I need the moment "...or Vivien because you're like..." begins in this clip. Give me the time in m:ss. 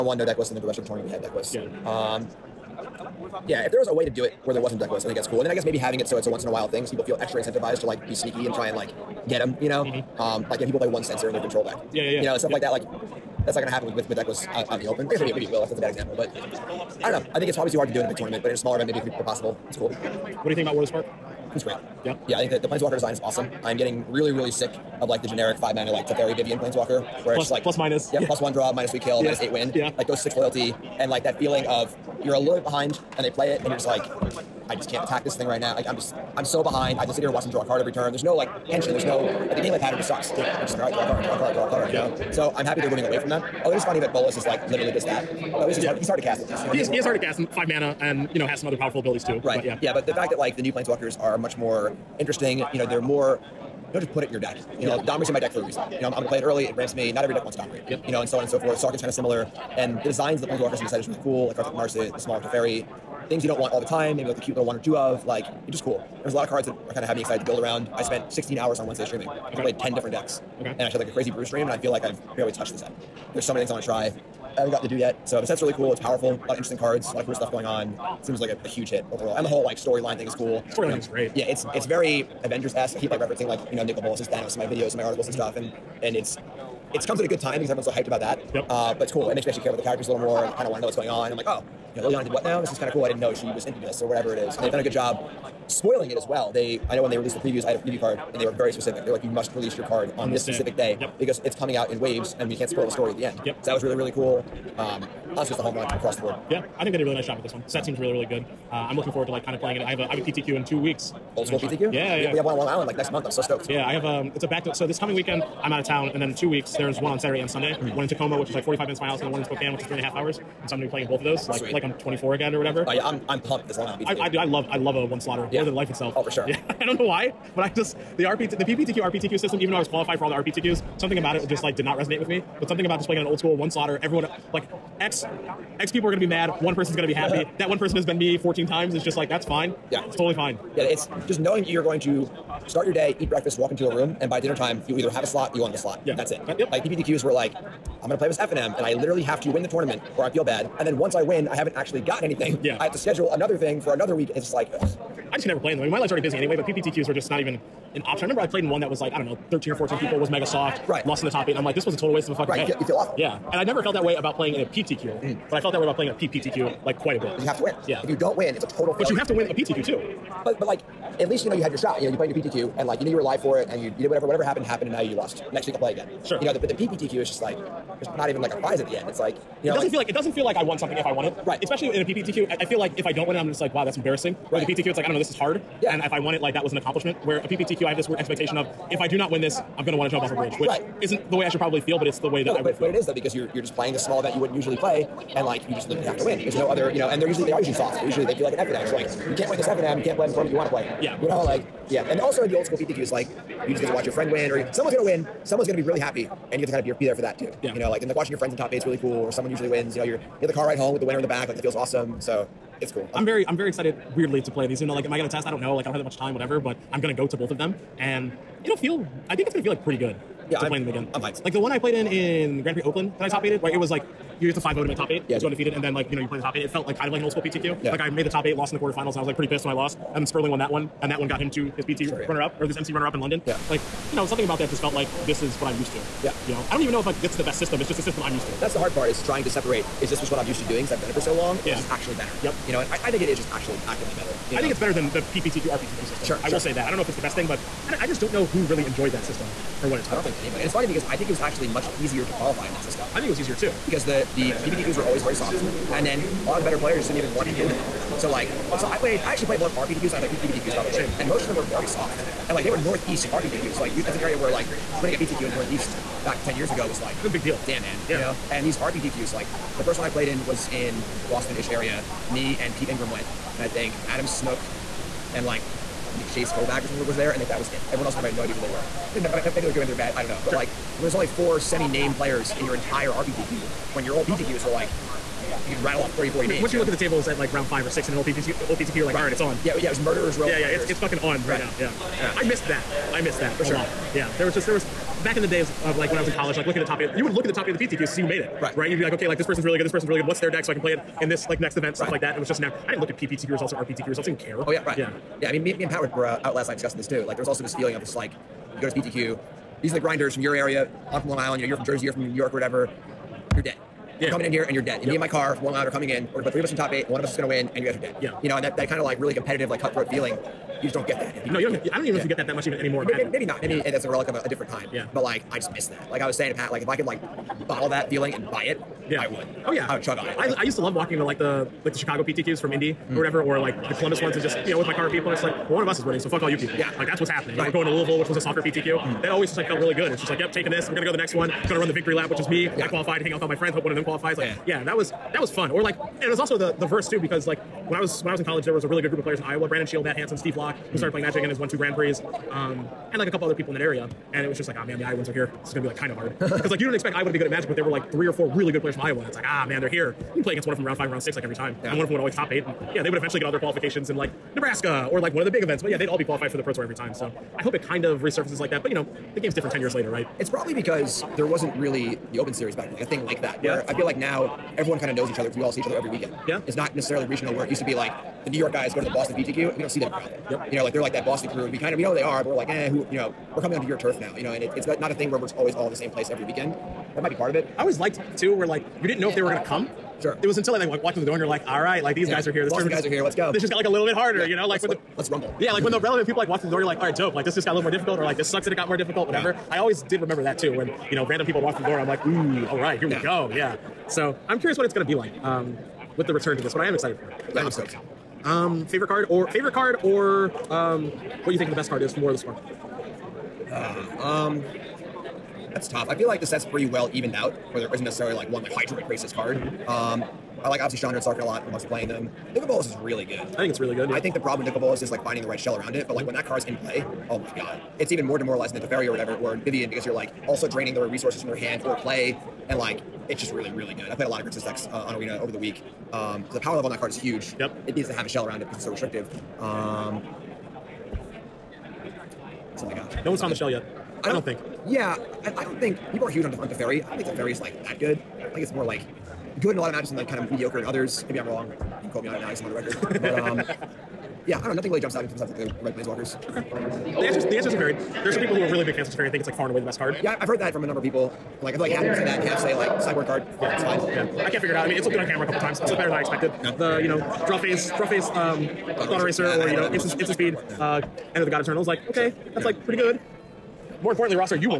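7:09.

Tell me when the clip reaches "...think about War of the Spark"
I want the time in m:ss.
0:20.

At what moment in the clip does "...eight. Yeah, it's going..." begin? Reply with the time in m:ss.
3:45.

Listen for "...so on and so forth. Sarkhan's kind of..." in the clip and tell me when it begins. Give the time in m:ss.
0:58.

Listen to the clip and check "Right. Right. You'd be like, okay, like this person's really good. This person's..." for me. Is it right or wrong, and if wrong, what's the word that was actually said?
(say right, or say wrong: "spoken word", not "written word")
right.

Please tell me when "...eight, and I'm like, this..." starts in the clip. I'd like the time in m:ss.
2:41.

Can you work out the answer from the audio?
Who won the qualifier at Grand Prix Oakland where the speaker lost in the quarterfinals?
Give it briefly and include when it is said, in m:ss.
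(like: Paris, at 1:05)
Sperling, at 3:50.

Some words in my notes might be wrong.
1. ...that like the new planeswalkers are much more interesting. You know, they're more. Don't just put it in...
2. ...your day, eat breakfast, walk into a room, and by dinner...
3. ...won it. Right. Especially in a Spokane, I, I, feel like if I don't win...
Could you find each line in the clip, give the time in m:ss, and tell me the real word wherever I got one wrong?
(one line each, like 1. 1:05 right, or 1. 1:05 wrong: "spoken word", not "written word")
1. 0:50 right
2. 2:22 right
3. 3:01 wrong: "PPTQ", not "Spokane".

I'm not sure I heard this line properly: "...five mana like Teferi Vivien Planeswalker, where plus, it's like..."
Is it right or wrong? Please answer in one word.
right.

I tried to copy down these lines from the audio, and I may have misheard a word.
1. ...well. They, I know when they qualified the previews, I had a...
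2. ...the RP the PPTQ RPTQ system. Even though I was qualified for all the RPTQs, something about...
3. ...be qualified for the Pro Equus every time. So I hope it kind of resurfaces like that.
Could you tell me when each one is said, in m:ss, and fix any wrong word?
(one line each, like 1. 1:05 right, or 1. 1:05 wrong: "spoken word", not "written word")
1. 1:36 wrong: "released", not "qualified"
2. 2:08 right
3. 6:06 wrong: "Tour", not "Equus".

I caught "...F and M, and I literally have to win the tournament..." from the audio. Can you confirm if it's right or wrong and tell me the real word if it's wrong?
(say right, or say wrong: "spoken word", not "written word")
right.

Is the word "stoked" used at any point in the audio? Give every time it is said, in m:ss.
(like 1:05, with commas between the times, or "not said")
1:53, 6:47.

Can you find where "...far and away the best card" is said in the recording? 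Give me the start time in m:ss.
7:39.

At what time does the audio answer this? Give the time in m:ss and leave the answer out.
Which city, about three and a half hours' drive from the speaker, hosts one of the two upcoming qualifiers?
1:59.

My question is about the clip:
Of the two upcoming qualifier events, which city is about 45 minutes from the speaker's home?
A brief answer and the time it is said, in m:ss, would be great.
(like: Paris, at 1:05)
Tacoma, at 1:58.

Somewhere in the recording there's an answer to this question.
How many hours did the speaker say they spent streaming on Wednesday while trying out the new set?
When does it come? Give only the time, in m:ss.
1:08.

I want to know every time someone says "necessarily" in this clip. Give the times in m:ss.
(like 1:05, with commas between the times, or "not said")
6:16, 6:58.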